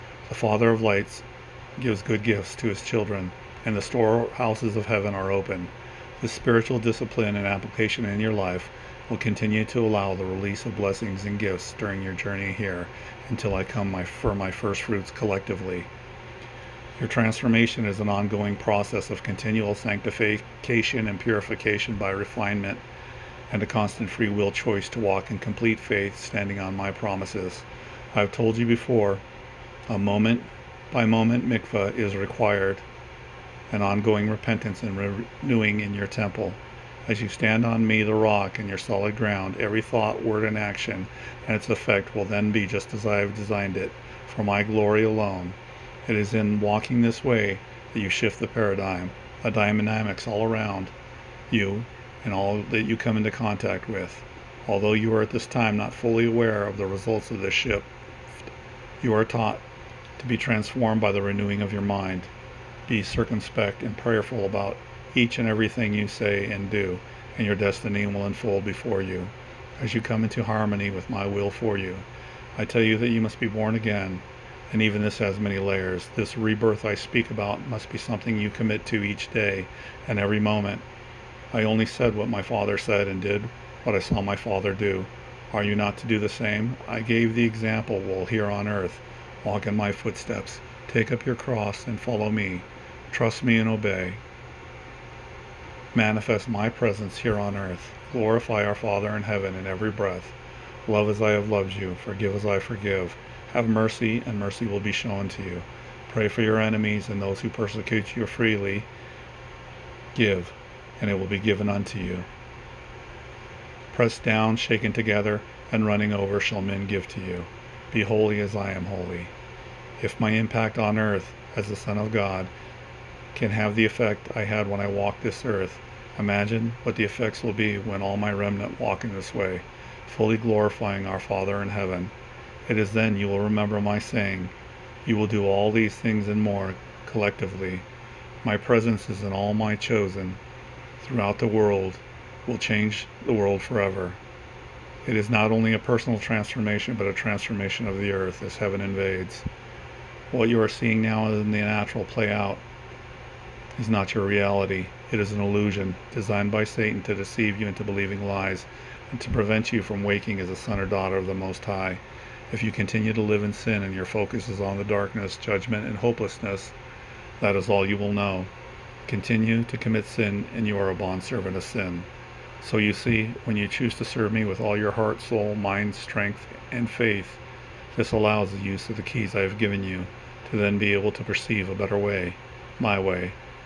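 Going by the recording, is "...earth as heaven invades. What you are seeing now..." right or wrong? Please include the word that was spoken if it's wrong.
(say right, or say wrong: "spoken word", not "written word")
right.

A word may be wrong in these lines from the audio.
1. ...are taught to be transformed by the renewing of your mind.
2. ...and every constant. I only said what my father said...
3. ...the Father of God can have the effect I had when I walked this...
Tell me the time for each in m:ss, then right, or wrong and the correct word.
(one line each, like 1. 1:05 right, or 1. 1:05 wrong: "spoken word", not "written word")
1. 0:59 right
2. 1:20 wrong: "moment", not "constant"
3. 2:01 wrong: "Son", not "Father".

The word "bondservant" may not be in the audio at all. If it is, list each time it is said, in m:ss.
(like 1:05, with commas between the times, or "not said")
2:50.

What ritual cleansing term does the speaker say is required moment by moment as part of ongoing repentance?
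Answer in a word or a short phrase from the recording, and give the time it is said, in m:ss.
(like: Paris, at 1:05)
mikvah, at 0:31.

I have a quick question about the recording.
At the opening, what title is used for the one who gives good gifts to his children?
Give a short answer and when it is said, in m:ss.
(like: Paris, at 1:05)
Father of lights, at 0:00.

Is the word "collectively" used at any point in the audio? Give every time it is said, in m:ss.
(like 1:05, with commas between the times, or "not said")
0:15, 2:17.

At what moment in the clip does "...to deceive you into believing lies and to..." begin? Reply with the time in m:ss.
2:37.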